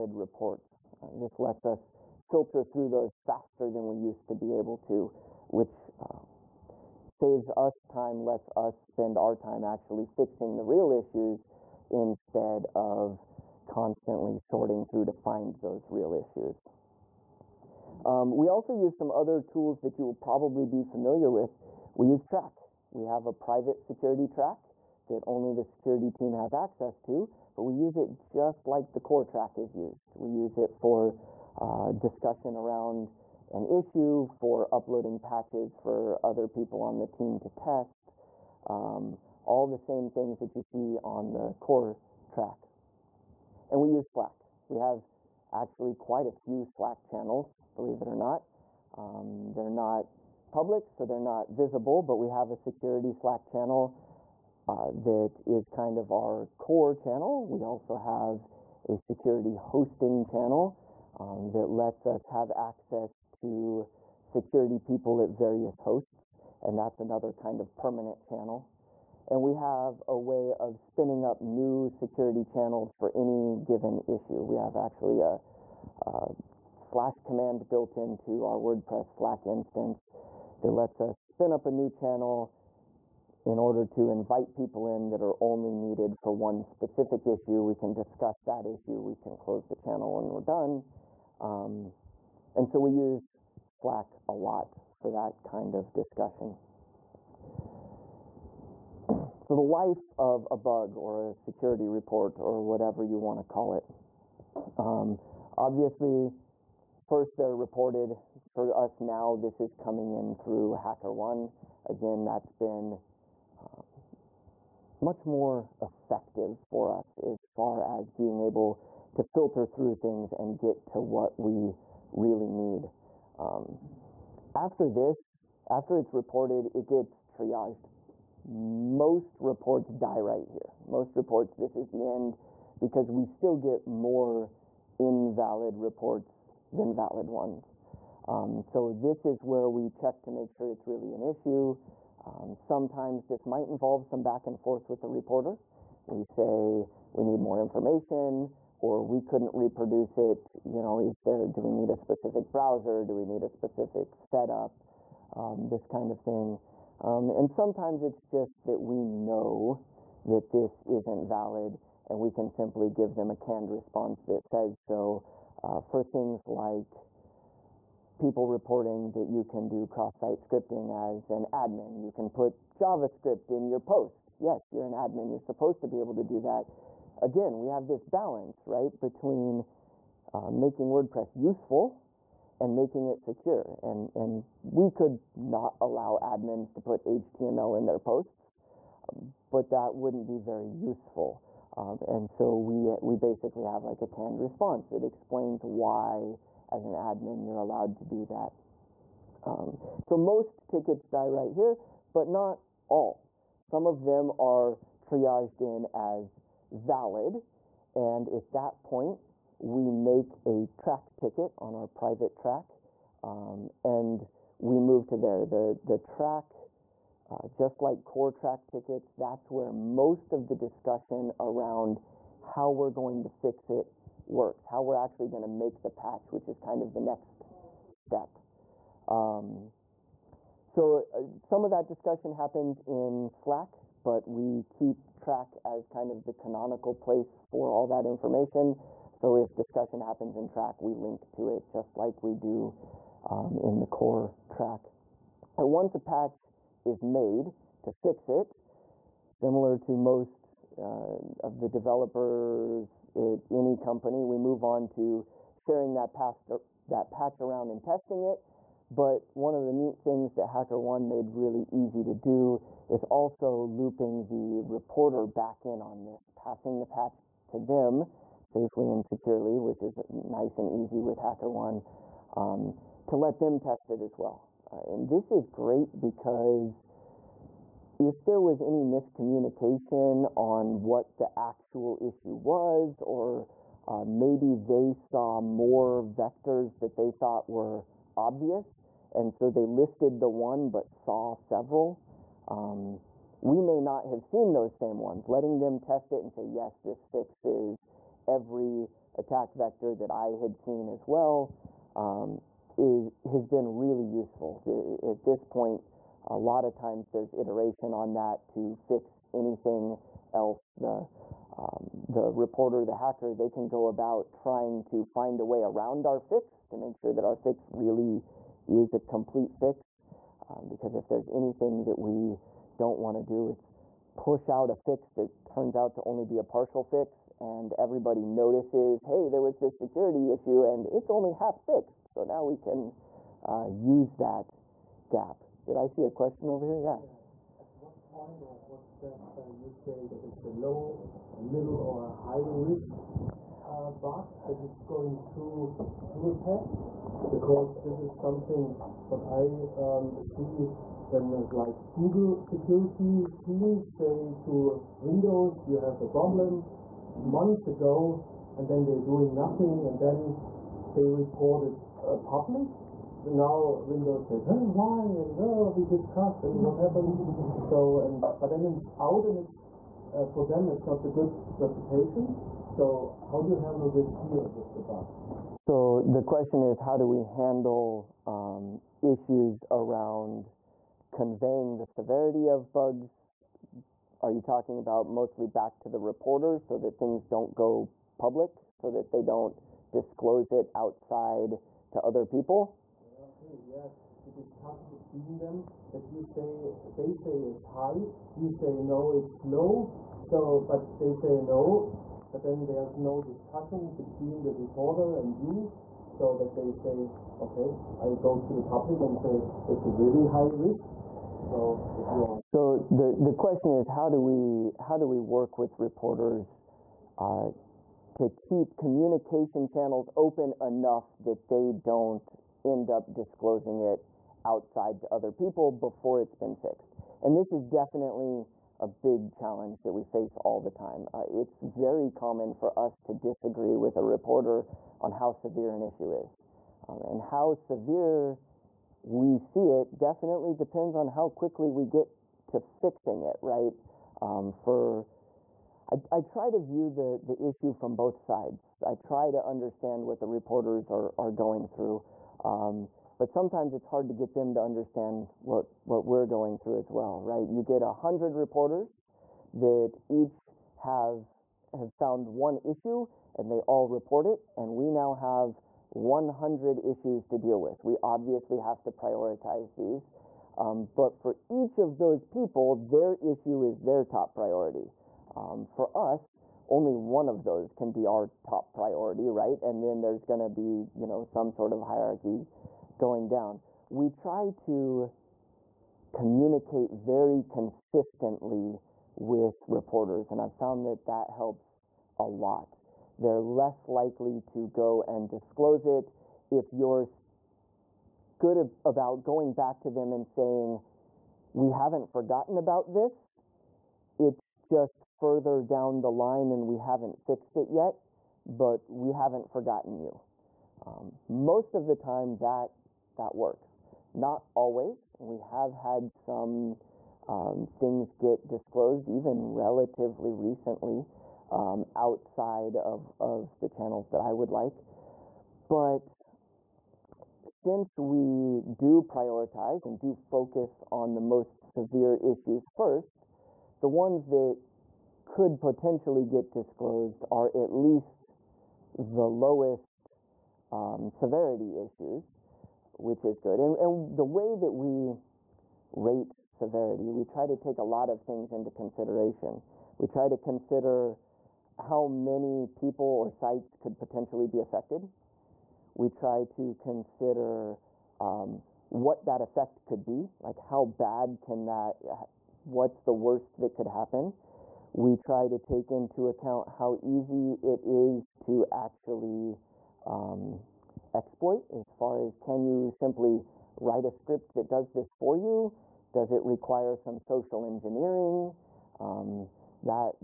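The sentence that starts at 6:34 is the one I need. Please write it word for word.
the discussion between them that you say they say it's high, you say no, it's low.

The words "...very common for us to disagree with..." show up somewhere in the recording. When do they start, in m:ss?
7:11.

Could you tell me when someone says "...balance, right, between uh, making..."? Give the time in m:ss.
2:58.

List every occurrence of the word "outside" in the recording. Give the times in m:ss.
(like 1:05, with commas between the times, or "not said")
6:30, 7:04, 8:41.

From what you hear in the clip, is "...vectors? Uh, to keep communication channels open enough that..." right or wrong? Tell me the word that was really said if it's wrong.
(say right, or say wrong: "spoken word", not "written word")
wrong: "reporters", not "vectors".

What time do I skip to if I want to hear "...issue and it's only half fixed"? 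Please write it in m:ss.
5:30.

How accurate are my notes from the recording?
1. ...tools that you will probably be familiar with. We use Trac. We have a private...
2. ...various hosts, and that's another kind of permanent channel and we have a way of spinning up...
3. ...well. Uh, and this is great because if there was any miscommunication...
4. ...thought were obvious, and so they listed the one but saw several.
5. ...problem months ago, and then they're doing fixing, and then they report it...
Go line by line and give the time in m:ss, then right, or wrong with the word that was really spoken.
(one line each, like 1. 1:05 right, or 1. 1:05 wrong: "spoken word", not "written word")
1. 0:19 right
2. 1:05 right
3. 4:34 right
4. 4:47 right
5. 5:56 wrong: "nothing", not "fixing".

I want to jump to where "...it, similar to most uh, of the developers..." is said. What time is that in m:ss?
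4:08.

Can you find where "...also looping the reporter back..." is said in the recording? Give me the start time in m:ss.
4:23.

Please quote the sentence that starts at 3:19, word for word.
Um, so most tickets die right here, but not all.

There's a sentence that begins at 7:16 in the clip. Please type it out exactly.
Um, and how severe we see it definitely depends on how quickly we get to fixing it, right?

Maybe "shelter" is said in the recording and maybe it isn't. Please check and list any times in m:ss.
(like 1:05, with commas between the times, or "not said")
not said.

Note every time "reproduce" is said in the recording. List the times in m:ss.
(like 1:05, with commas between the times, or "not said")
2:29.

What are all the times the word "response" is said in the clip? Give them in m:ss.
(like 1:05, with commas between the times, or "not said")
2:43, 3:14.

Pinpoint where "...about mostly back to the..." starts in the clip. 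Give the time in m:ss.
6:24.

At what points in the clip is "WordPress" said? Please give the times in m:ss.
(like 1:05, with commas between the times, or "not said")
1:18, 3:00.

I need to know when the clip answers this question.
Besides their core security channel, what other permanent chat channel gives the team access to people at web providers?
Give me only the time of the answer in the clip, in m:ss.
0:58.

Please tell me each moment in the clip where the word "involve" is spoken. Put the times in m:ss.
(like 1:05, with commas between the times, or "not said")
2:23.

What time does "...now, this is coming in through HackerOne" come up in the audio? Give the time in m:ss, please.
1:48.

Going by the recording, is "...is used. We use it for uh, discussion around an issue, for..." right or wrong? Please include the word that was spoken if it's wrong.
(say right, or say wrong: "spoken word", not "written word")
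right.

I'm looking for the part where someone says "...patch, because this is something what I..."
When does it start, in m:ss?
5:46.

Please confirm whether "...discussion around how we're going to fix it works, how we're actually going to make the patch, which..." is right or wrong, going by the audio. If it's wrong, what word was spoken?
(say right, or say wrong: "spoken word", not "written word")
right.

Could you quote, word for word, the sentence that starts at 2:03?
Um, after this, after it's reported, it gets triaged most reports die right here.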